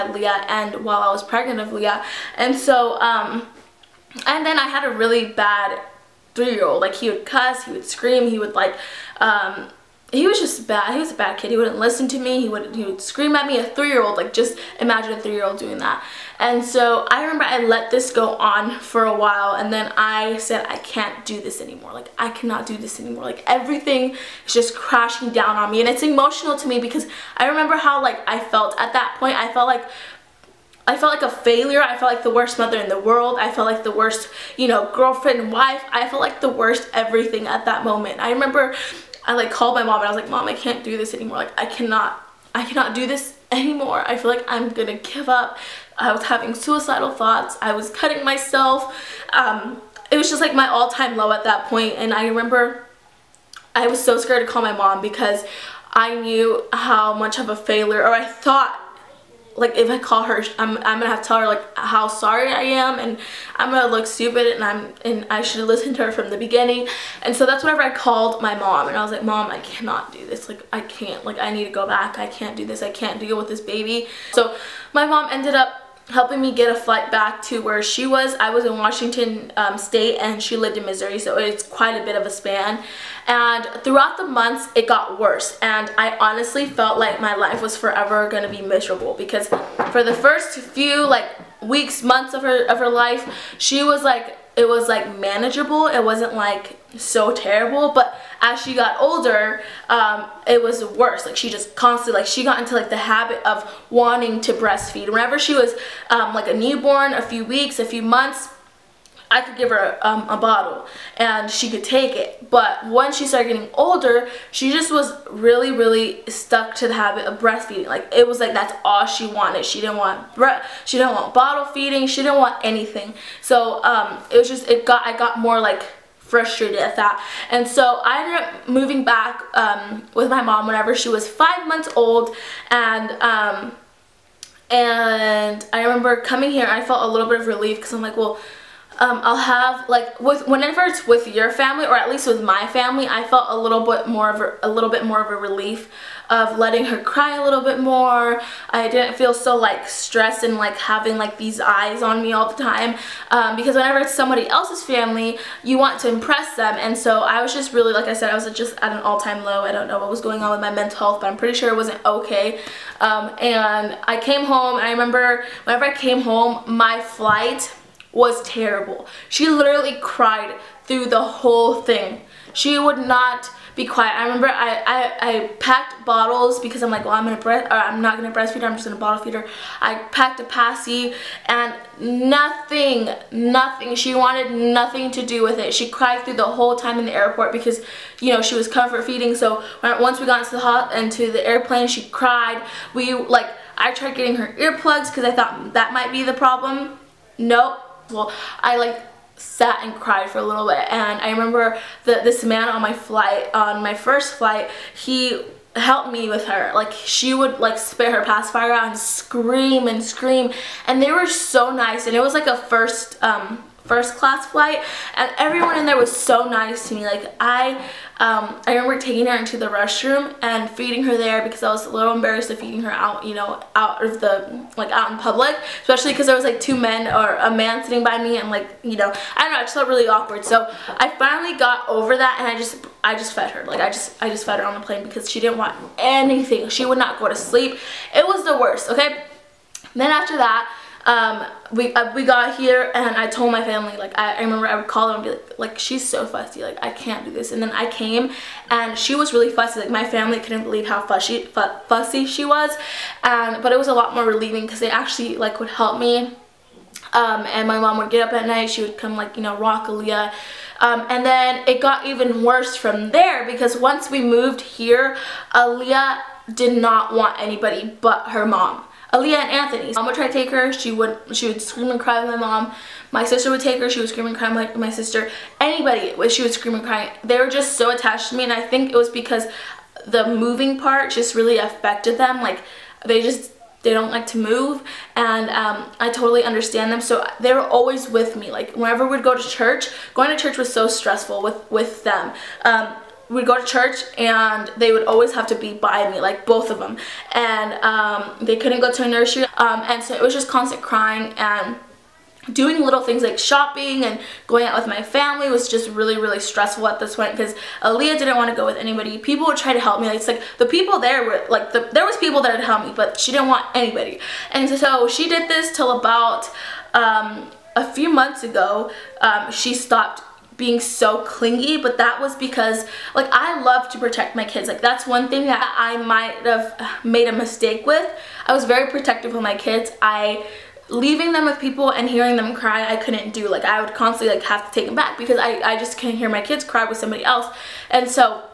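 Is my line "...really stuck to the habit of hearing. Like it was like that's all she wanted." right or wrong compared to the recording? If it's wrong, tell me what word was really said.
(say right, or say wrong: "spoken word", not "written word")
wrong: "breastfeeding", not "hearing".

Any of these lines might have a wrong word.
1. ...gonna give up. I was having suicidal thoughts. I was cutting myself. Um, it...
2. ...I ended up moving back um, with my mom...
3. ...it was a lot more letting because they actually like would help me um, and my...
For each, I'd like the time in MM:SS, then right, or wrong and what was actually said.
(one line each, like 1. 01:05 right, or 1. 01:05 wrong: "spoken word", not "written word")
1. 00:44 right
2. 02:08 right
3. 04:13 wrong: "relieving", not "letting".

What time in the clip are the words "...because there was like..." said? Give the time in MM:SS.
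03:46.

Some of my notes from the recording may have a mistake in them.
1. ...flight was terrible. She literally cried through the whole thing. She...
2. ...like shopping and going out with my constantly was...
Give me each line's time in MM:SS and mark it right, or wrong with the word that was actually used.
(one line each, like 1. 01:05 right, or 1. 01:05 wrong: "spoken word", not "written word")
1. 02:47 right
2. 05:03 wrong: "family", not "constantly".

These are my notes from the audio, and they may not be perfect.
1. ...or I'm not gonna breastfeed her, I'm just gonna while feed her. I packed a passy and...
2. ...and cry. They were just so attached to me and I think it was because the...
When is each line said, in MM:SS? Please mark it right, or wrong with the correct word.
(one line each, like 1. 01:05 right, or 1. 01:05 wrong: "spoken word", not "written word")
1. 02:57 wrong: "bottle", not "while"
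2. 04:36 right.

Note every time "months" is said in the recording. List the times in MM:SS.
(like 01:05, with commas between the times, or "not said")
01:24, 01:32, 01:48, 02:11, 05:18.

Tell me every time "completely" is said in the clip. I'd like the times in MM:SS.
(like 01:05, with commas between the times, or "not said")
not said.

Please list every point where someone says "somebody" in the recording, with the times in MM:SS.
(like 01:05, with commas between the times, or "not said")
02:34, 05:36.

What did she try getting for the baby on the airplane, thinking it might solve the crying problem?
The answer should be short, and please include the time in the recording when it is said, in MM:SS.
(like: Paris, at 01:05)
earplugs, at 03:14.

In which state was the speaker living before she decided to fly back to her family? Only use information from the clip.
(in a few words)
Washington.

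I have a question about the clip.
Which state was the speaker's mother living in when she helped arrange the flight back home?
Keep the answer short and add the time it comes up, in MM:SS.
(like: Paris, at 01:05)
Missouri, at 01:20.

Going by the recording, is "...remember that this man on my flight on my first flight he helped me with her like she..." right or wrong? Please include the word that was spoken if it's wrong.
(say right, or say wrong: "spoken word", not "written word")
right.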